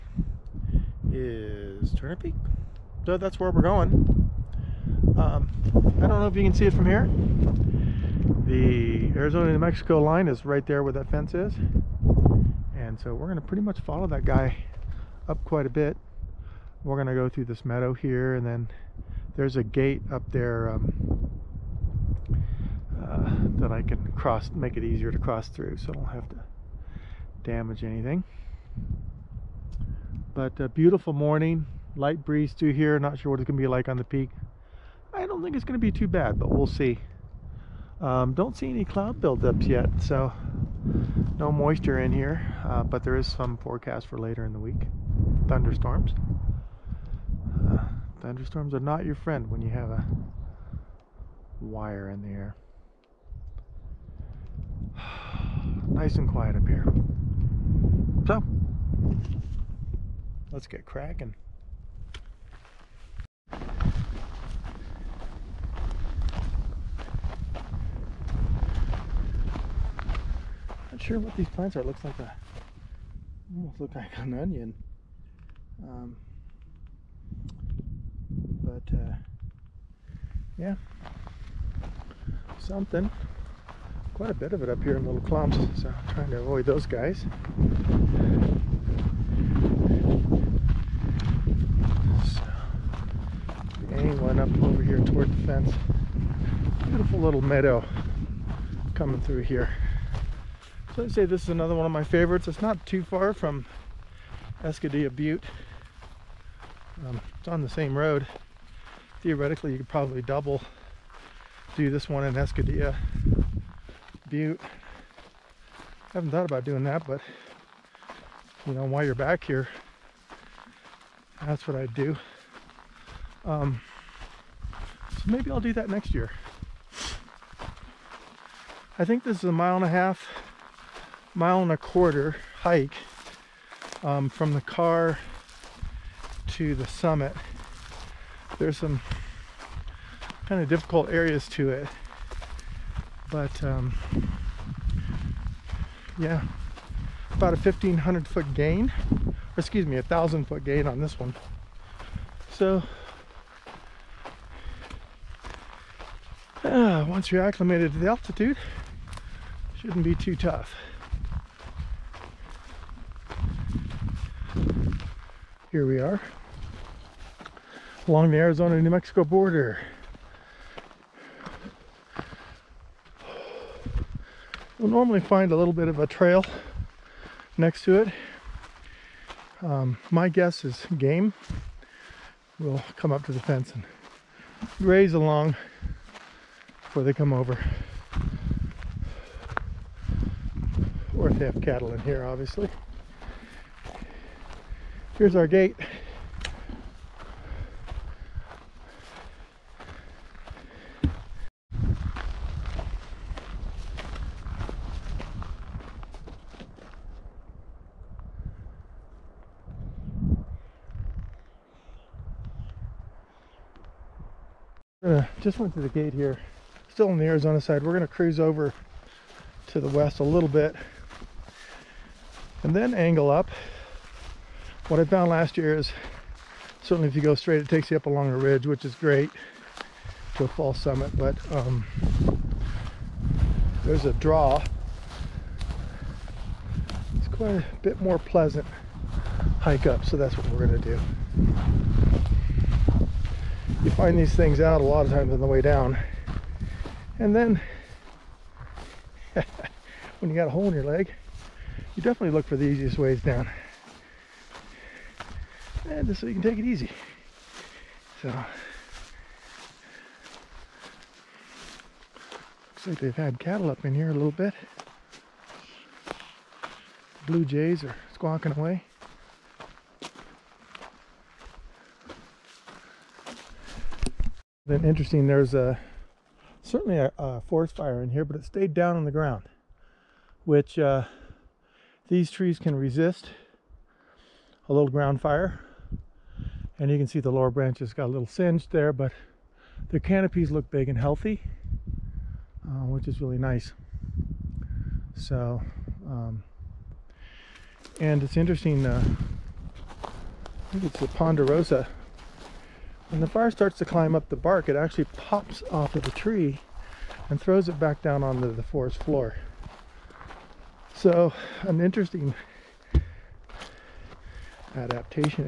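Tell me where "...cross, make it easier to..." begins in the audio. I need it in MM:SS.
00:24.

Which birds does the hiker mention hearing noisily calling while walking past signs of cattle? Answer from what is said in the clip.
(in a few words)
Blue jays.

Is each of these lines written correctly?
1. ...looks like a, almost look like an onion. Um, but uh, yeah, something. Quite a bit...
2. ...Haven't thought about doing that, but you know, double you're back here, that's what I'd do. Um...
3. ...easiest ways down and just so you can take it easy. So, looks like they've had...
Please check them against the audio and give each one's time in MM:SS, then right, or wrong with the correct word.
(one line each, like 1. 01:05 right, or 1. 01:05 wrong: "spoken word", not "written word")
1. 01:11 right
2. 01:56 wrong: "while", not "double"
3. 04:12 right.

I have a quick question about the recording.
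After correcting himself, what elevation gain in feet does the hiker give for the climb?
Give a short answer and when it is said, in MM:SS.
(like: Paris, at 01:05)
1000 feet, at 02:29.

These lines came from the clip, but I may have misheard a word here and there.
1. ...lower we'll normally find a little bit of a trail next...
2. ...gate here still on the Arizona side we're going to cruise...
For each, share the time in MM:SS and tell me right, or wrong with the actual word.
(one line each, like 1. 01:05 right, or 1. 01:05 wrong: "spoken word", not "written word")
1. 02:49 wrong: "border", not "lower"
2. 03:35 right.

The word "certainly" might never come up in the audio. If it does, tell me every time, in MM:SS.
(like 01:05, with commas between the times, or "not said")
03:46, 04:36.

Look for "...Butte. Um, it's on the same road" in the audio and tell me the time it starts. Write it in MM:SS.
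01:45.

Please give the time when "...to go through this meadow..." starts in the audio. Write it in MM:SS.
00:17.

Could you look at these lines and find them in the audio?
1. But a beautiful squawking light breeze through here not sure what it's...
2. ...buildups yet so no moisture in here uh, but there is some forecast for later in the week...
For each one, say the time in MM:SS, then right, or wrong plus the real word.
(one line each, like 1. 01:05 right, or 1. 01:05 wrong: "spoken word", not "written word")
1. 00:30 wrong: "morning", not "squawking"
2. 00:39 right.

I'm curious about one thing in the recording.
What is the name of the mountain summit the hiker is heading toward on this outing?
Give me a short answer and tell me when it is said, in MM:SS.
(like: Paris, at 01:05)
Turner Peak, at 00:01.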